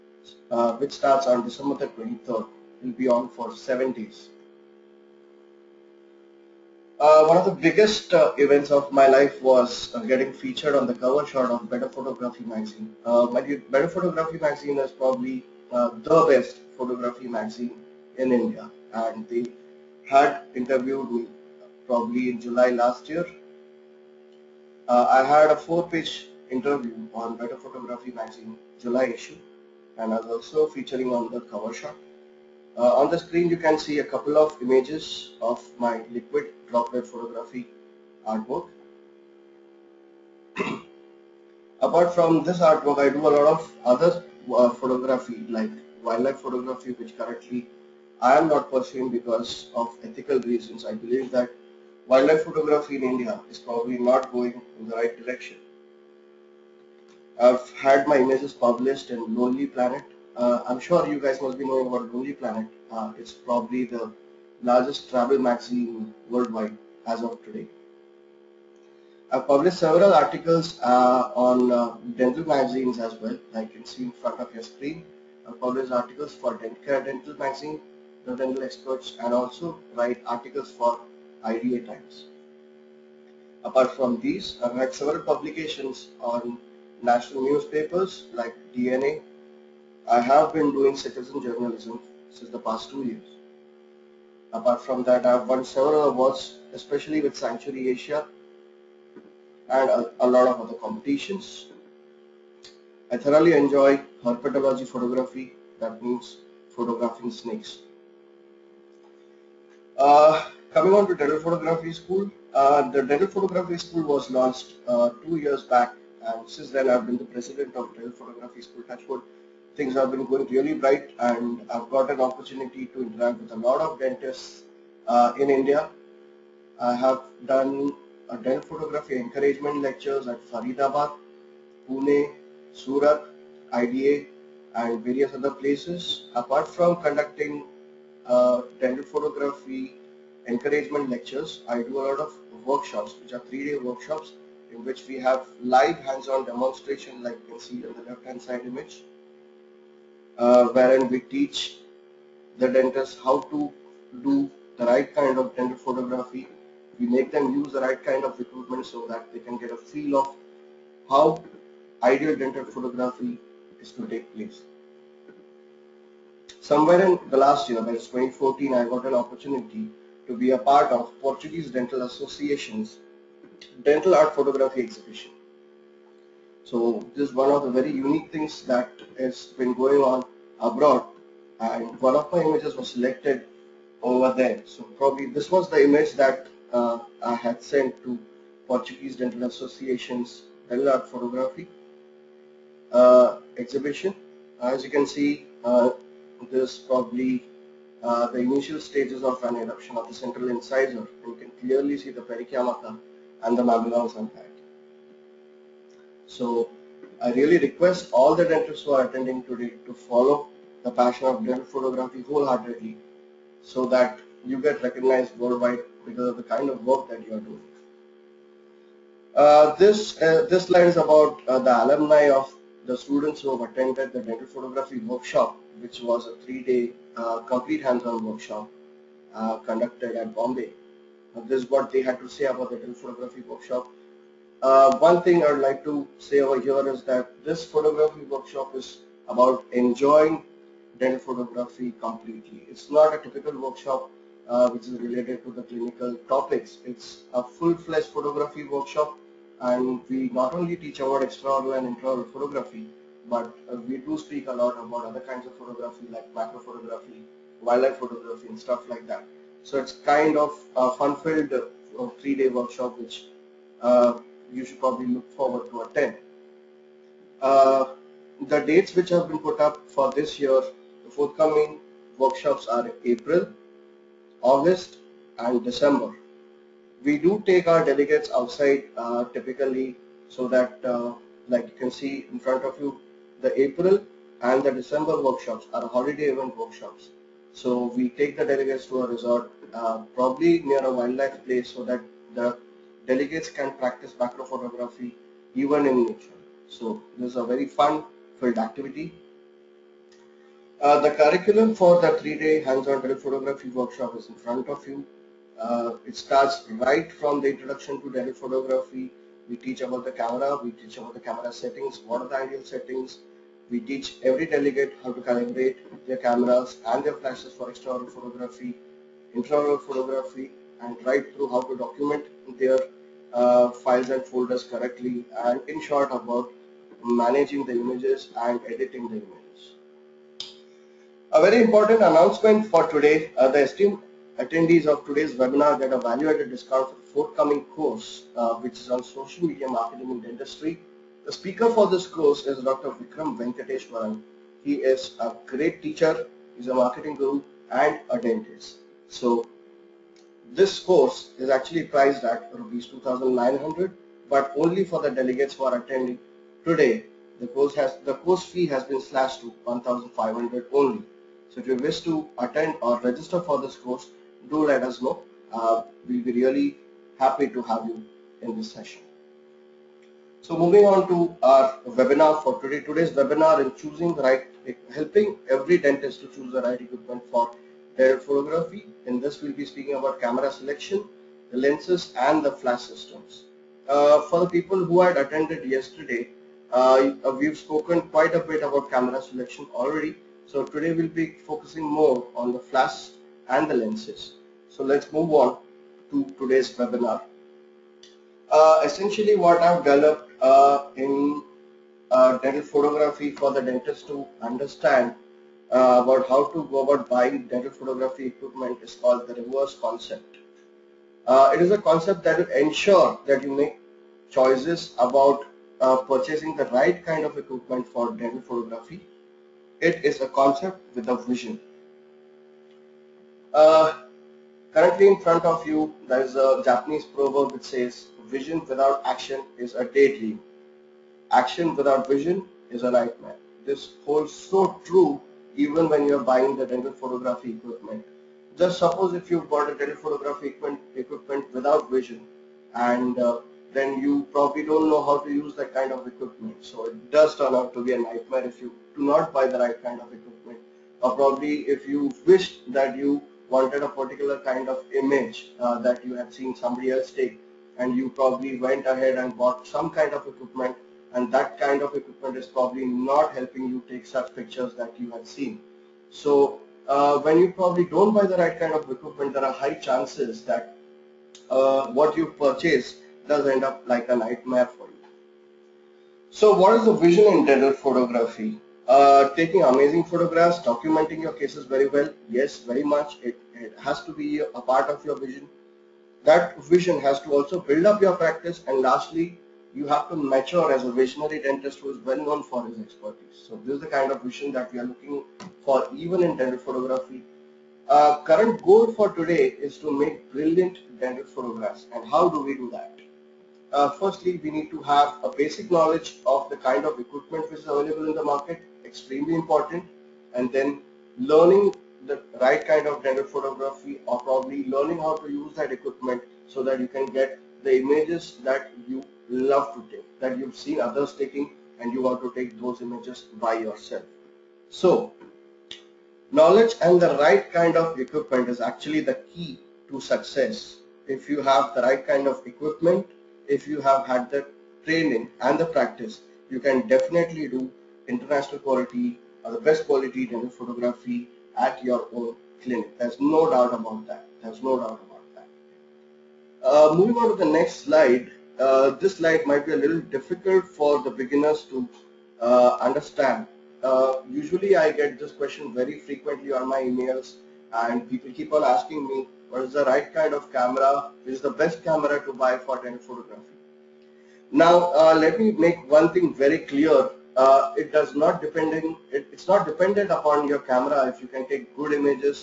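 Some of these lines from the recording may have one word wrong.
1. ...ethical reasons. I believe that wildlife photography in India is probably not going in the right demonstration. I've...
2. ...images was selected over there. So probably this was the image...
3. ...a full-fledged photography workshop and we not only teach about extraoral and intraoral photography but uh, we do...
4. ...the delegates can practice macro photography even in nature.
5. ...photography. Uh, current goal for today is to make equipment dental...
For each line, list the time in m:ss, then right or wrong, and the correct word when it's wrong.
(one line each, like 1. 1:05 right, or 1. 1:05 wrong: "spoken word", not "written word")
1. 0:50 wrong: "direction", not "demonstration"
2. 3:02 right
3. 4:07 right
4. 4:52 right
5. 8:16 wrong: "brilliant", not "equipment".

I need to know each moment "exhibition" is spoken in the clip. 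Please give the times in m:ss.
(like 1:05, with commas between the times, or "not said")
2:54, 3:13.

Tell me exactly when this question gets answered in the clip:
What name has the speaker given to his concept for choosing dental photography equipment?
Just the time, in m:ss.
6:49.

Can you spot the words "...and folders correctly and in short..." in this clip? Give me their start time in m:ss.
5:24.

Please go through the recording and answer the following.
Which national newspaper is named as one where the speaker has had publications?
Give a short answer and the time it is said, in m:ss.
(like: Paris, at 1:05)
DNA, at 1:28.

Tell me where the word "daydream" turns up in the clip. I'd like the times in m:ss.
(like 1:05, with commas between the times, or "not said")
7:09.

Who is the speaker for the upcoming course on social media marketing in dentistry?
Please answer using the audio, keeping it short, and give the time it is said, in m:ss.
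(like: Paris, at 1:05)
Dr. Vikram Venkateshwaran, at 5:42.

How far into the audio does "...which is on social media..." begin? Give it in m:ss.
5:38.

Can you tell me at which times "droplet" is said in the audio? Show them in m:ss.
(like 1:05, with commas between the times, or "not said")
0:36.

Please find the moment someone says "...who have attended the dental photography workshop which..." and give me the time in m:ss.
3:43.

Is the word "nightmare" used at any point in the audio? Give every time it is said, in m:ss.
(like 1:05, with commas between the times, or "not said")
7:12, 7:27, 7:54.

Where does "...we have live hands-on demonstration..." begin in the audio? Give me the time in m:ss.
2:25.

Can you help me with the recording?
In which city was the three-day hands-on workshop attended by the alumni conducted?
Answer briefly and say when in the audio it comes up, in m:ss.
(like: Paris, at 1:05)
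Bombay, at 3:50.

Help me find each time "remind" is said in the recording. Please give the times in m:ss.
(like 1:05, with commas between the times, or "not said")
not said.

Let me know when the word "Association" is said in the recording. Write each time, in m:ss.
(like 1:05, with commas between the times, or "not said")
2:52, 3:09.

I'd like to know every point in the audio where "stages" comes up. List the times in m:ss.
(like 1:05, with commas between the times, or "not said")
3:18.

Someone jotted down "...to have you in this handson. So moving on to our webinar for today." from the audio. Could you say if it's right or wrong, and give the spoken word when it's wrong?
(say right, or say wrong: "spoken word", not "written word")
wrong: "session", not "handson".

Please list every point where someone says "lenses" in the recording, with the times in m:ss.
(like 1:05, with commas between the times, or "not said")
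6:21, 6:33.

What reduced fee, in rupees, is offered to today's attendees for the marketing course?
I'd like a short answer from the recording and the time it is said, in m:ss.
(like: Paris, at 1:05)
1500, at 5:59.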